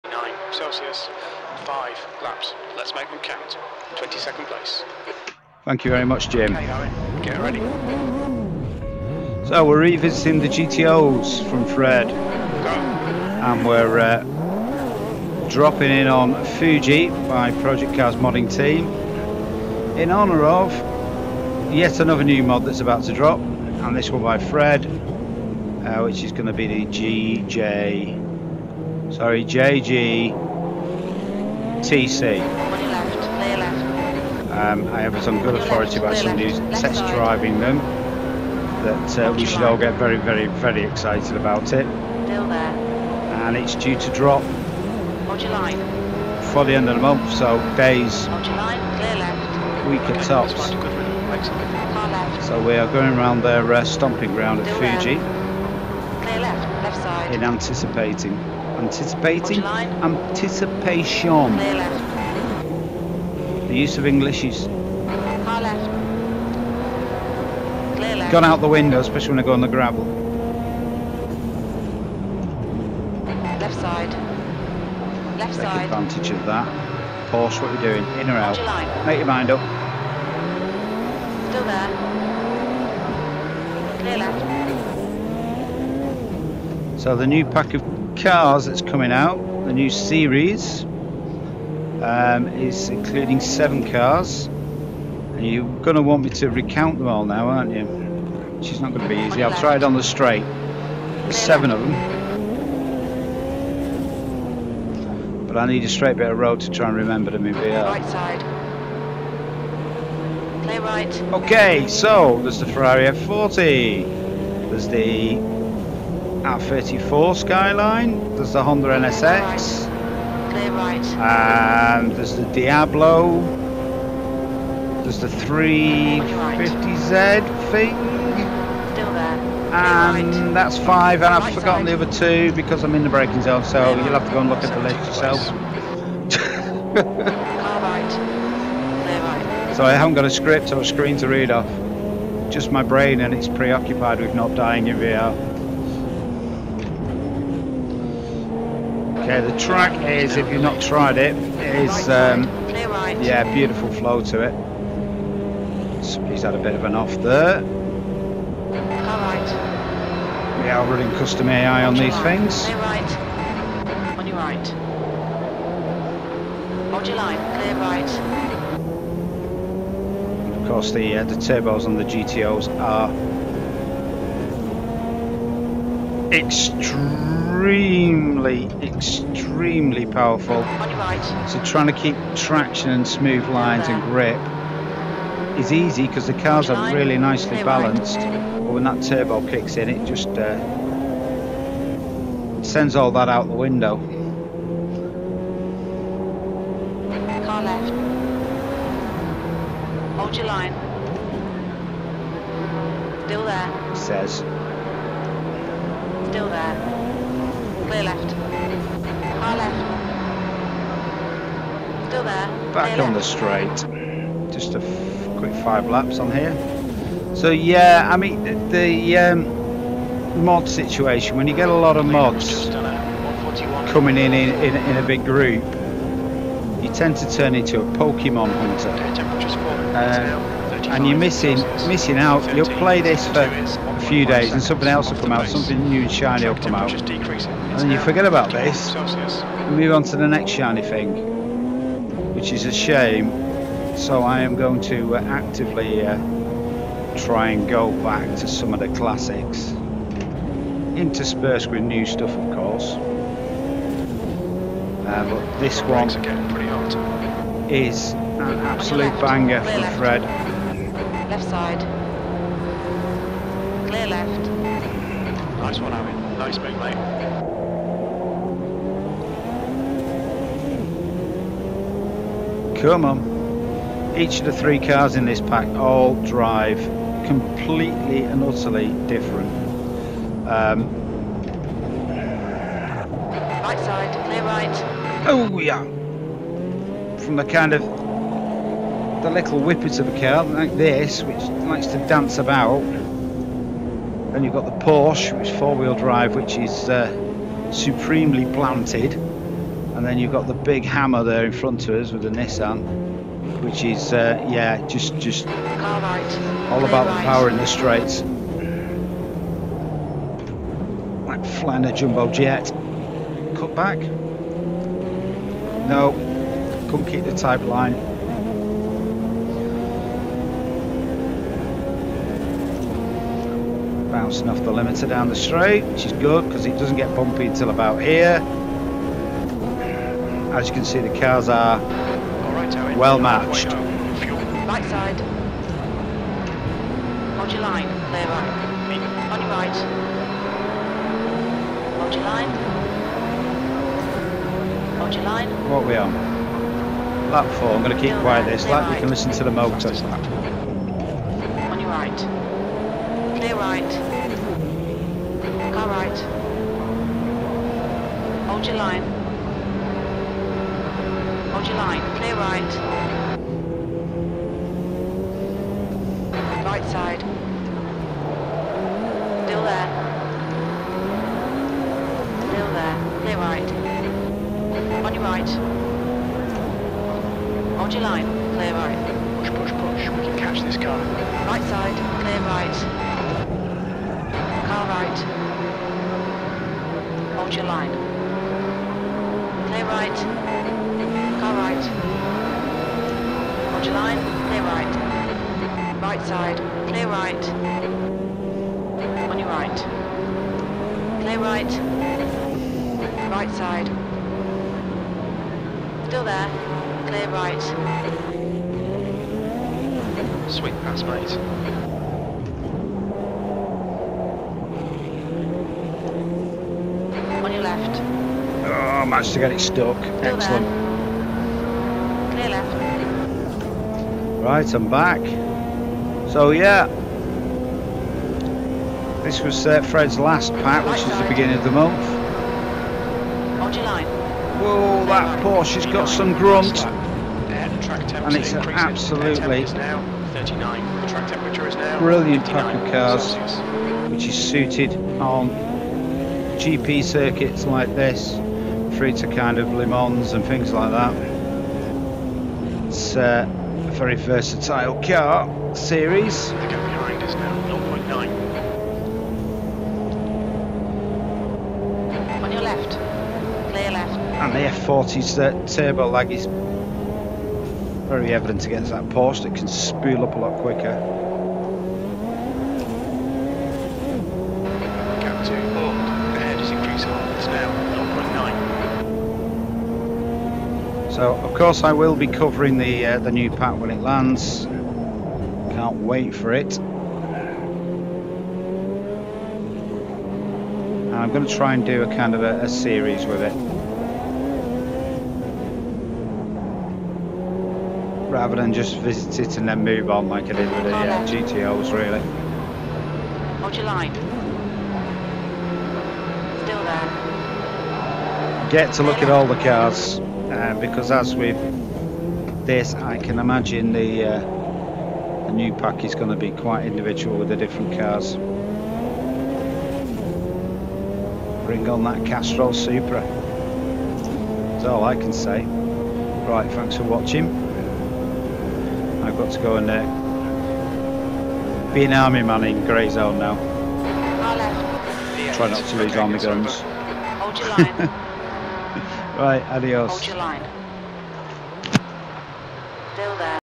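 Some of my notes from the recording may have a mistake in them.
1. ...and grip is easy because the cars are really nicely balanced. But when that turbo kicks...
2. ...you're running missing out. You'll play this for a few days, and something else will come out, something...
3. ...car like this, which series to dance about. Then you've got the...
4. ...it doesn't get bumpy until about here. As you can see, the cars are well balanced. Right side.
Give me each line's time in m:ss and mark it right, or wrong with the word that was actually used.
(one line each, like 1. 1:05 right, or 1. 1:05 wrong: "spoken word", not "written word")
1. 3:03 right
2. 3:51 wrong: "missing", not "running"
3. 4:50 wrong: "likes", not "series"
4. 5:26 wrong: "matched", not "balanced".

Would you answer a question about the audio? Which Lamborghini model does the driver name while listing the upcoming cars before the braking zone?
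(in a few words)
Diablo.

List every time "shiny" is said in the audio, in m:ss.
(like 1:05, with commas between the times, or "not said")
3:56, 4:00.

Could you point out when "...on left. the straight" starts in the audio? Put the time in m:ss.
3:33.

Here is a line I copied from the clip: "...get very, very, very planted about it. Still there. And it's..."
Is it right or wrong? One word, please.
wrong.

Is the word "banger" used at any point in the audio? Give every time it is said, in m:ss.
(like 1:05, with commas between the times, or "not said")
4:19.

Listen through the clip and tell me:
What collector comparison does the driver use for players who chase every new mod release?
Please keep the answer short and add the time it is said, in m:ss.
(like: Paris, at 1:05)
Pokemon hunter, at 3:47.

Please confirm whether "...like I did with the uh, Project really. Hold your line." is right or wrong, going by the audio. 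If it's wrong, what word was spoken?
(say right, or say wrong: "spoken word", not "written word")
wrong: "GTOs", not "Project".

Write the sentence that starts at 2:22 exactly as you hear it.
Just my brain, and it's preoccupied with not dying in VR.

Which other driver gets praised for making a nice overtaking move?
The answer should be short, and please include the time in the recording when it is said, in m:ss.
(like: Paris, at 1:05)
Owen, at 4:25.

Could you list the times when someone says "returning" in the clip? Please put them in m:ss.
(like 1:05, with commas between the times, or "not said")
not said.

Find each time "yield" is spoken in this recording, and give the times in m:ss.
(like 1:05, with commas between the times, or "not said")
not said.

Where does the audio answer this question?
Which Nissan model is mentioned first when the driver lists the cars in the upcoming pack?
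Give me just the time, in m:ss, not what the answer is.
1:56.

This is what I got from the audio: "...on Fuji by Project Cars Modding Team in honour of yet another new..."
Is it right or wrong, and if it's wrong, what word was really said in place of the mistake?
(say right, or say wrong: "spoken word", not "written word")
right.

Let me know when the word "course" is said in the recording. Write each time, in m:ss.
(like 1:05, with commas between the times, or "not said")
2:50, 4:12, 8:01.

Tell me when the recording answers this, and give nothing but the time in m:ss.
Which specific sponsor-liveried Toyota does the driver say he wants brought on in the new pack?
8:42.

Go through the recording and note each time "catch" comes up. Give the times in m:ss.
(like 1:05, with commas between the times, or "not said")
6:20.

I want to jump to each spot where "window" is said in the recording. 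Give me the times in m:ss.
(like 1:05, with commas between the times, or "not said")
1:08, 3:13.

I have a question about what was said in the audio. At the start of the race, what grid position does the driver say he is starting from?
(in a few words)
22nd.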